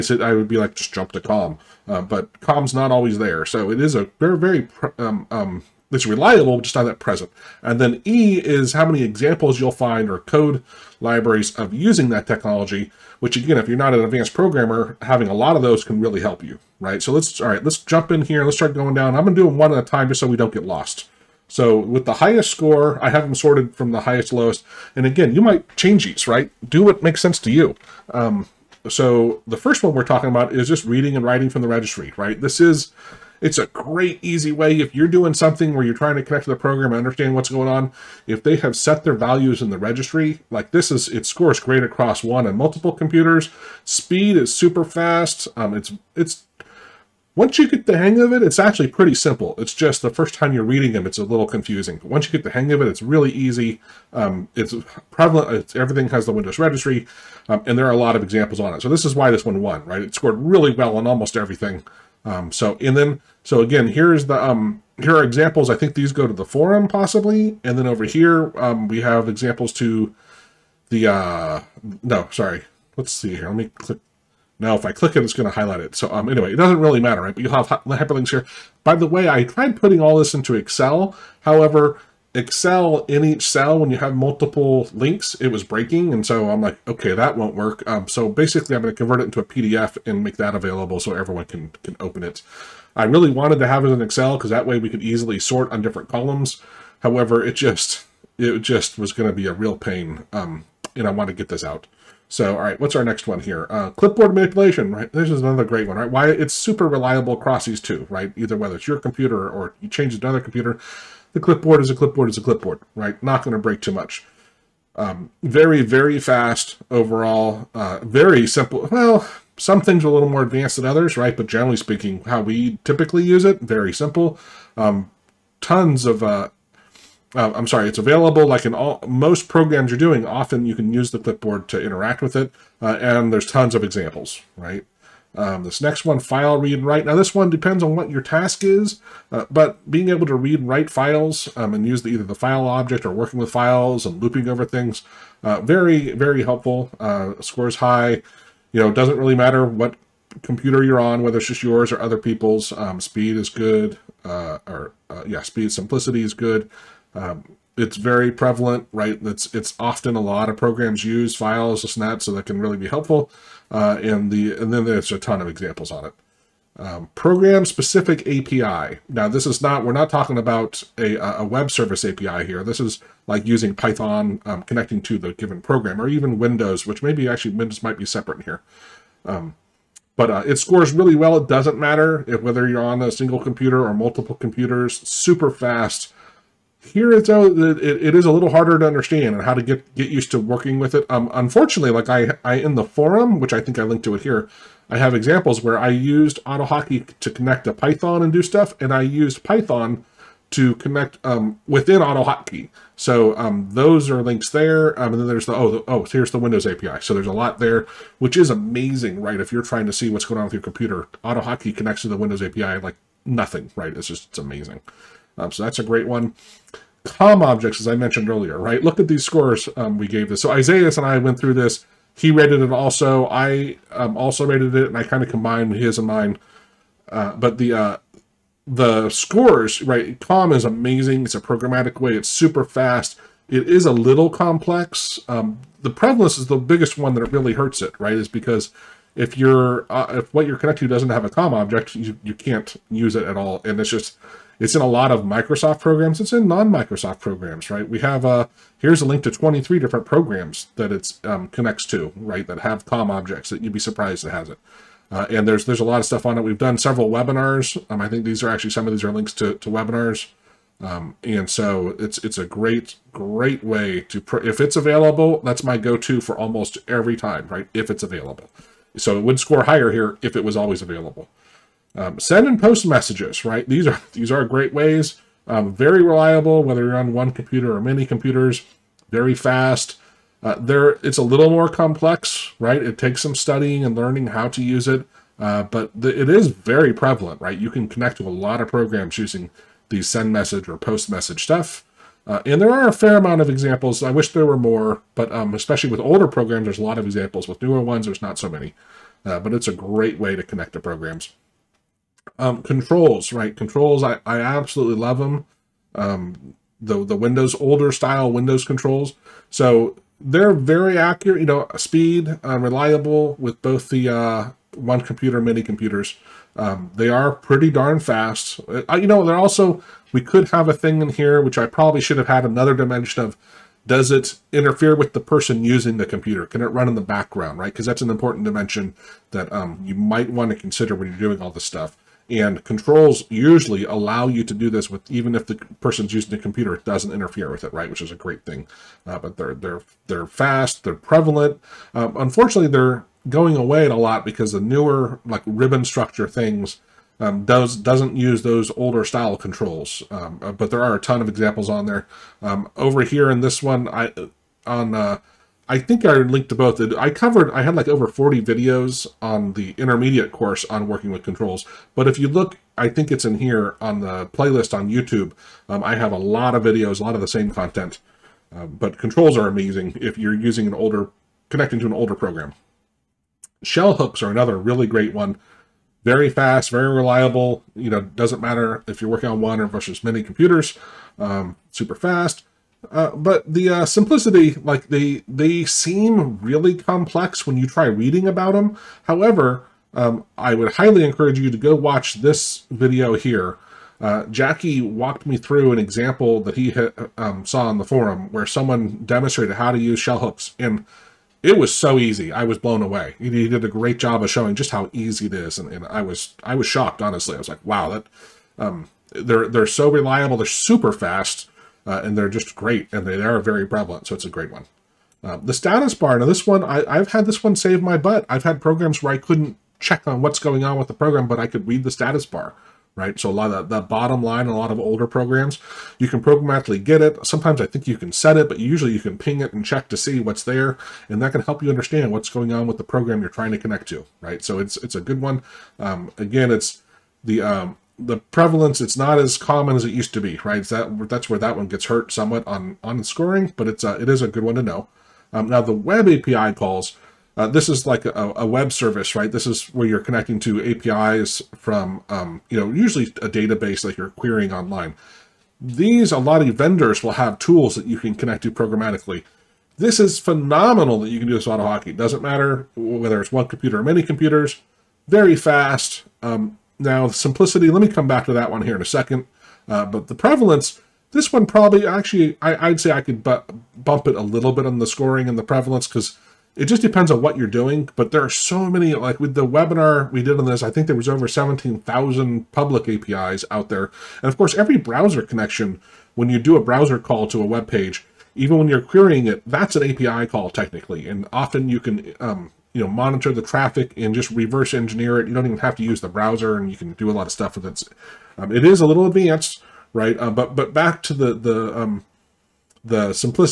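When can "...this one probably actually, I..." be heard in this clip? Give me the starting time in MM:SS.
07:51.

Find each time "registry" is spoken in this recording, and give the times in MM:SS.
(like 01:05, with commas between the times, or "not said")
00:31, 00:39, 00:56.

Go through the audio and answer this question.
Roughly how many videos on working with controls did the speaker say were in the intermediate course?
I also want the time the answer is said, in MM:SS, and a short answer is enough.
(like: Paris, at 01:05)
over 40, at 05:57.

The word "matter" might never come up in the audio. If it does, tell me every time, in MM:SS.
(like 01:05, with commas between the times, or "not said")
01:17, 02:29, 03:01, 06:18, 07:42.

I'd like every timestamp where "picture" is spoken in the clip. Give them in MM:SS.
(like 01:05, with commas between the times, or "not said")
not said.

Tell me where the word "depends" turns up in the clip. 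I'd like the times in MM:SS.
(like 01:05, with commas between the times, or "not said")
02:17, 07:56.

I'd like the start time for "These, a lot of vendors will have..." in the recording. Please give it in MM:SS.
07:35.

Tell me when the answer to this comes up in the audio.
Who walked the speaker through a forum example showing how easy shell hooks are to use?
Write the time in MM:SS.
06:34.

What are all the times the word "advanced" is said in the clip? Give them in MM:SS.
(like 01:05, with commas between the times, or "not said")
00:14, 02:00, 08:19.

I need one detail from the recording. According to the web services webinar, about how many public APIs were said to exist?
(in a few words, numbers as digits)
17,000.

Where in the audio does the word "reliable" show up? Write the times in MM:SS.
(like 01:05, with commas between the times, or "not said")
00:06, 01:46, 04:36, 05:12, 06:16, 06:49.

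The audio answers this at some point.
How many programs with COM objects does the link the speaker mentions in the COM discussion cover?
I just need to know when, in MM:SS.
04:09.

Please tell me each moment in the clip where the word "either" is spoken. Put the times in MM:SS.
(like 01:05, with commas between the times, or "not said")
01:48, 02:22.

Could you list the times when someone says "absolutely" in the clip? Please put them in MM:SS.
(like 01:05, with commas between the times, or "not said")
05:04.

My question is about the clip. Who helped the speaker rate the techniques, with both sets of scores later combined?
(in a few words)
Isaias.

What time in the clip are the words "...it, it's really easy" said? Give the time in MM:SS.
00:52.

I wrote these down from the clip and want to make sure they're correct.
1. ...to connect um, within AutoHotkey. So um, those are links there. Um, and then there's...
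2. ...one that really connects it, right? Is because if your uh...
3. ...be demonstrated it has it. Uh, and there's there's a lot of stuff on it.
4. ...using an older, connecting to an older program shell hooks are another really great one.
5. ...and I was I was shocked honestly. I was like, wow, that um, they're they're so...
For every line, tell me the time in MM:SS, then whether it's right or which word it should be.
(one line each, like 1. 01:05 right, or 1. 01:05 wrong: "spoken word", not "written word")
1. 03:20 right
2. 03:56 wrong: "hurts", not "connects"
3. 04:13 wrong: "surprised", not "demonstrated"
4. 06:10 right
5. 06:45 right.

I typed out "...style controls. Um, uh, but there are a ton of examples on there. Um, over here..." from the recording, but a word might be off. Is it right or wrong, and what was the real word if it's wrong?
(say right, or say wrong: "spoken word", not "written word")
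right.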